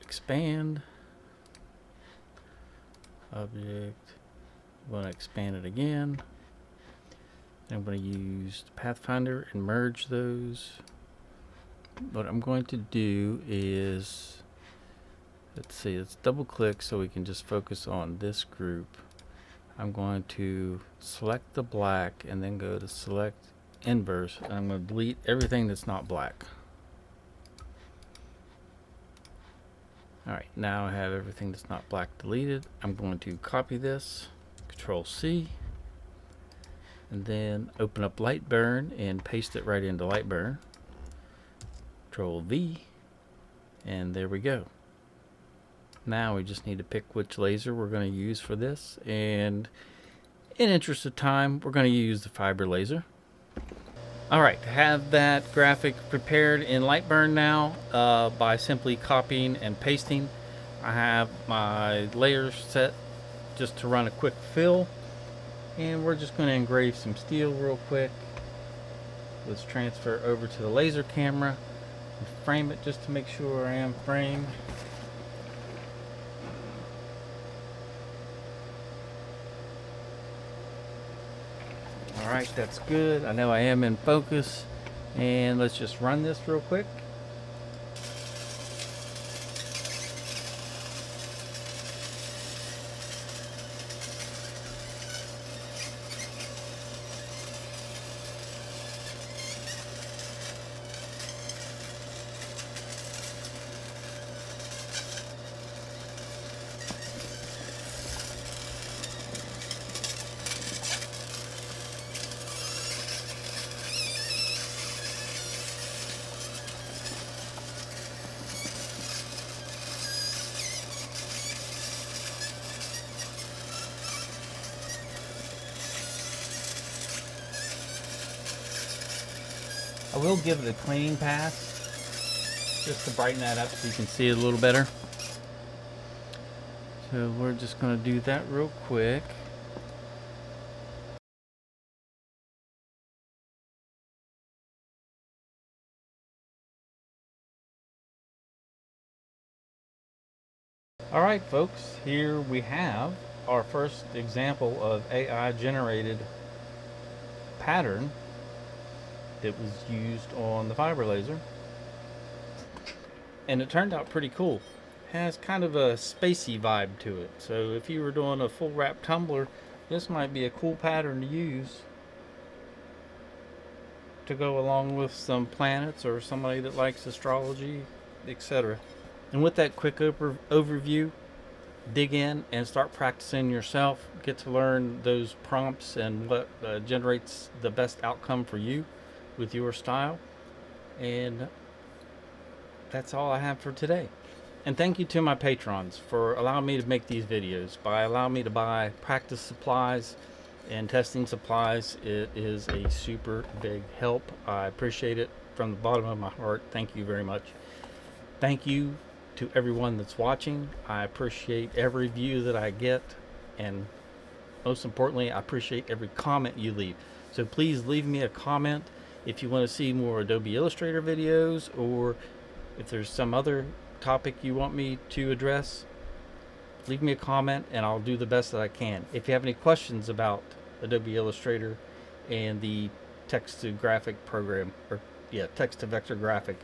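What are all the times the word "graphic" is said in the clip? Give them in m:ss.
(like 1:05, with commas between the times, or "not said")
0:55, 3:53.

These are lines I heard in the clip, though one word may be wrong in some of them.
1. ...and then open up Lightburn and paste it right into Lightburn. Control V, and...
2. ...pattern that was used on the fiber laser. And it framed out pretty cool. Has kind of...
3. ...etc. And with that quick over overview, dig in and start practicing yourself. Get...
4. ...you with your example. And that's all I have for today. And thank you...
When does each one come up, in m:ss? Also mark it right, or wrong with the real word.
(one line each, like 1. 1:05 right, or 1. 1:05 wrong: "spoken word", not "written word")
1. 0:37 right
2. 2:37 wrong: "turned", not "framed"
3. 2:58 right
4. 3:08 wrong: "style", not "example".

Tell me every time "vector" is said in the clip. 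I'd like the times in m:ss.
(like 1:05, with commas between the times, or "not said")
3:55.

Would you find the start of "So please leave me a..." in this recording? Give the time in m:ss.
3:37.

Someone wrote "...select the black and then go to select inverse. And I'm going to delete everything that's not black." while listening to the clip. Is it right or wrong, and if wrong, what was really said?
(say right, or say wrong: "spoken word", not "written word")
right.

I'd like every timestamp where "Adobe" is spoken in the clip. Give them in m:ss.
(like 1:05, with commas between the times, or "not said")
3:40, 3:50.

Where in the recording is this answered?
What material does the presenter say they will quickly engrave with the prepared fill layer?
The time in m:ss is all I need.
1:07.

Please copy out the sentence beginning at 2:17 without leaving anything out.
So we're just going to do that real quick.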